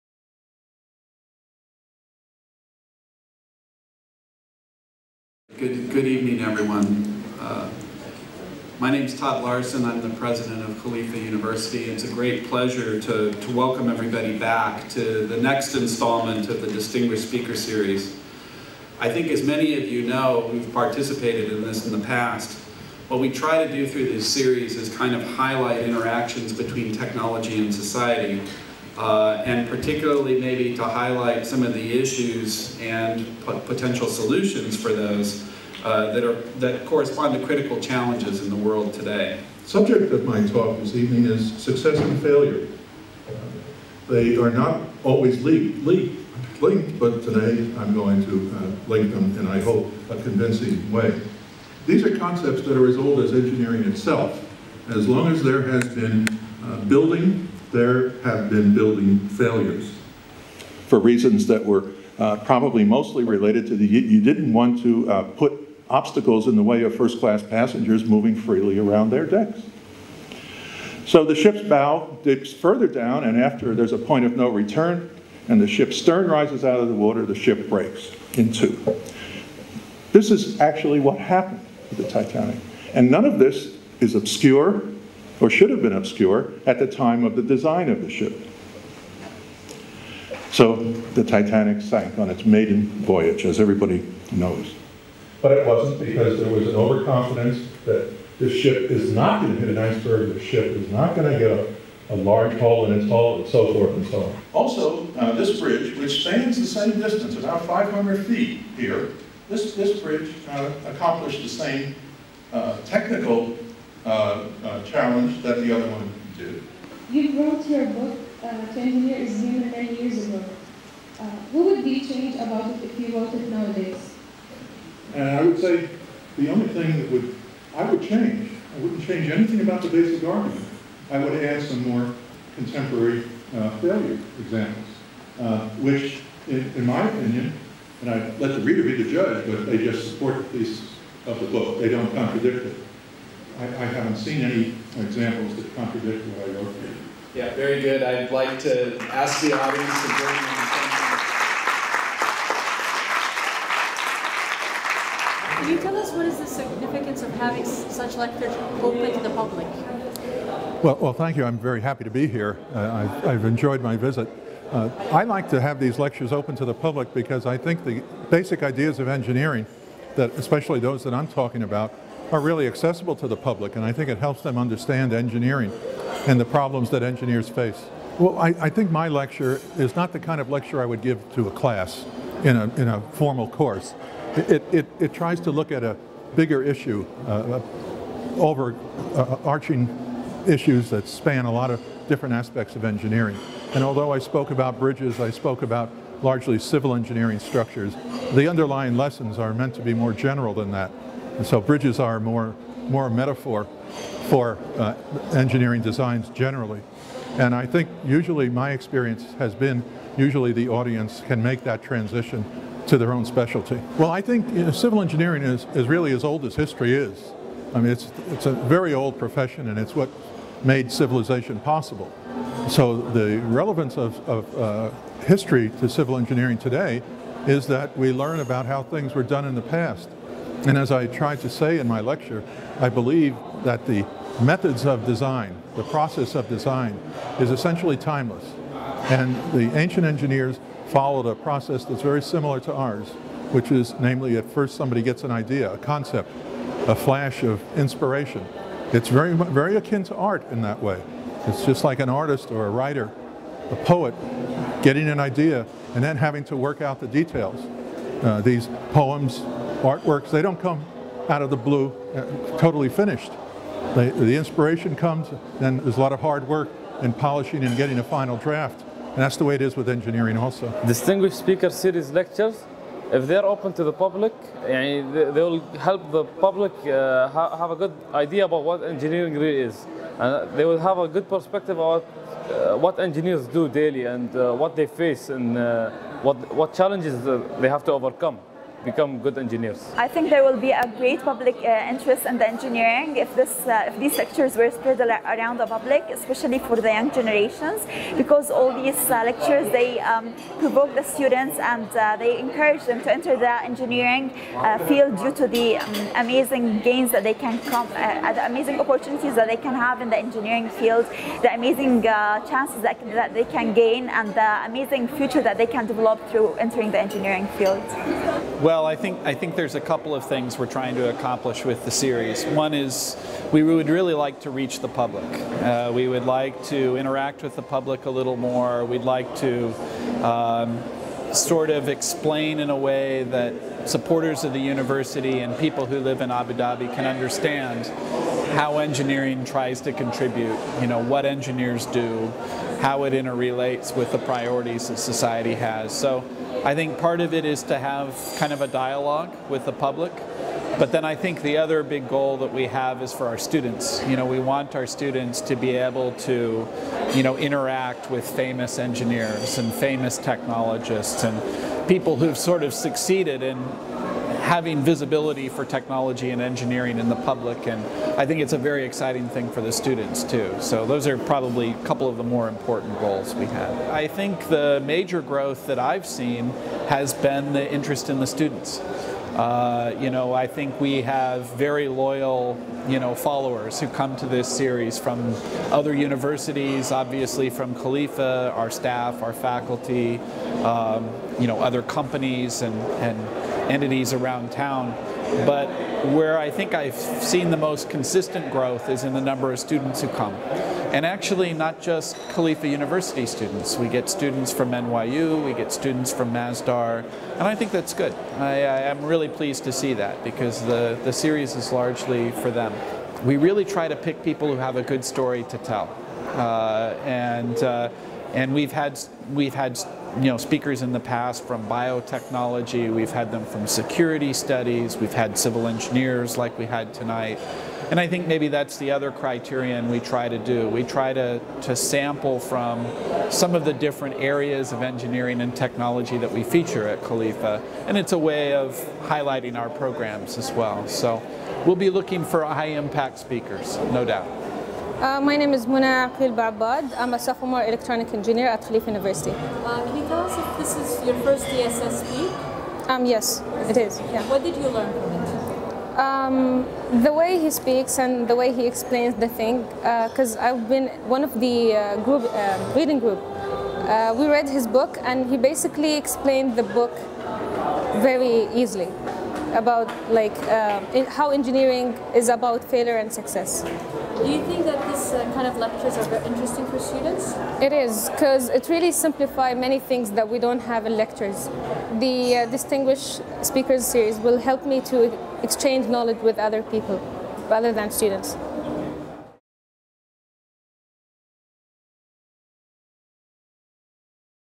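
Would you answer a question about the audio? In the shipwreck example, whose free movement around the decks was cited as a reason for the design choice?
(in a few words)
first-class passengers.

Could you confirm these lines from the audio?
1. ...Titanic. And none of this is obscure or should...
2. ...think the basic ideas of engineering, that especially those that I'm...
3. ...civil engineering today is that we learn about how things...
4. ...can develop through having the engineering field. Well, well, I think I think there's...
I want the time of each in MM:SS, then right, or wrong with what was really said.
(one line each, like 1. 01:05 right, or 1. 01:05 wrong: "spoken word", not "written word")
1. 01:22 right
2. 02:47 right
3. 03:45 right
4. 05:15 wrong: "entering", not "having".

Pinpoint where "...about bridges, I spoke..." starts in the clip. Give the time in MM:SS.
03:14.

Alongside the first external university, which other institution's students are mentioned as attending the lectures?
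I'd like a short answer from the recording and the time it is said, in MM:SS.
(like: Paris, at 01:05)
Masdar, at 06:46.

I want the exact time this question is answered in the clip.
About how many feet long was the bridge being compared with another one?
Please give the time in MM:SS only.
01:47.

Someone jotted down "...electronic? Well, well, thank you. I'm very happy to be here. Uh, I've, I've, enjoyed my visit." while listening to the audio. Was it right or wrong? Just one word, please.
wrong.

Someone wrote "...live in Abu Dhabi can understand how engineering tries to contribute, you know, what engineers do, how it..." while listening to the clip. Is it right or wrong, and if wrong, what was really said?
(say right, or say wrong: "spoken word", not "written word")
right.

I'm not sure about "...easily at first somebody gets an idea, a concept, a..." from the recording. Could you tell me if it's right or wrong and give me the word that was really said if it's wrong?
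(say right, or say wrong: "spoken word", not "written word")
wrong: "namely", not "easily".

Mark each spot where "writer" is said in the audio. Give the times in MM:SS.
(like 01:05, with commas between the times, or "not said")
04:12.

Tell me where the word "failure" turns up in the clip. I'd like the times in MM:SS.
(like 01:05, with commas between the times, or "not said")
00:42, 00:59, 02:13, 07:52.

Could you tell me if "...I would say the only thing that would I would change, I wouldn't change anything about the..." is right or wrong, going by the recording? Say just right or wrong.
right.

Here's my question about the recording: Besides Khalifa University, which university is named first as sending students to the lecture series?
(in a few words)
NYU.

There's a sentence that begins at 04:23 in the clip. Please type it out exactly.
They, the inspiration comes, then there's a lot of hard work and polishing and getting a final draft.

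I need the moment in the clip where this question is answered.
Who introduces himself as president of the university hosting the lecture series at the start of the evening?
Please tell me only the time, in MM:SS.
00:09.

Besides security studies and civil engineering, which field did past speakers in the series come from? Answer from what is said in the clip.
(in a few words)
biotechnology.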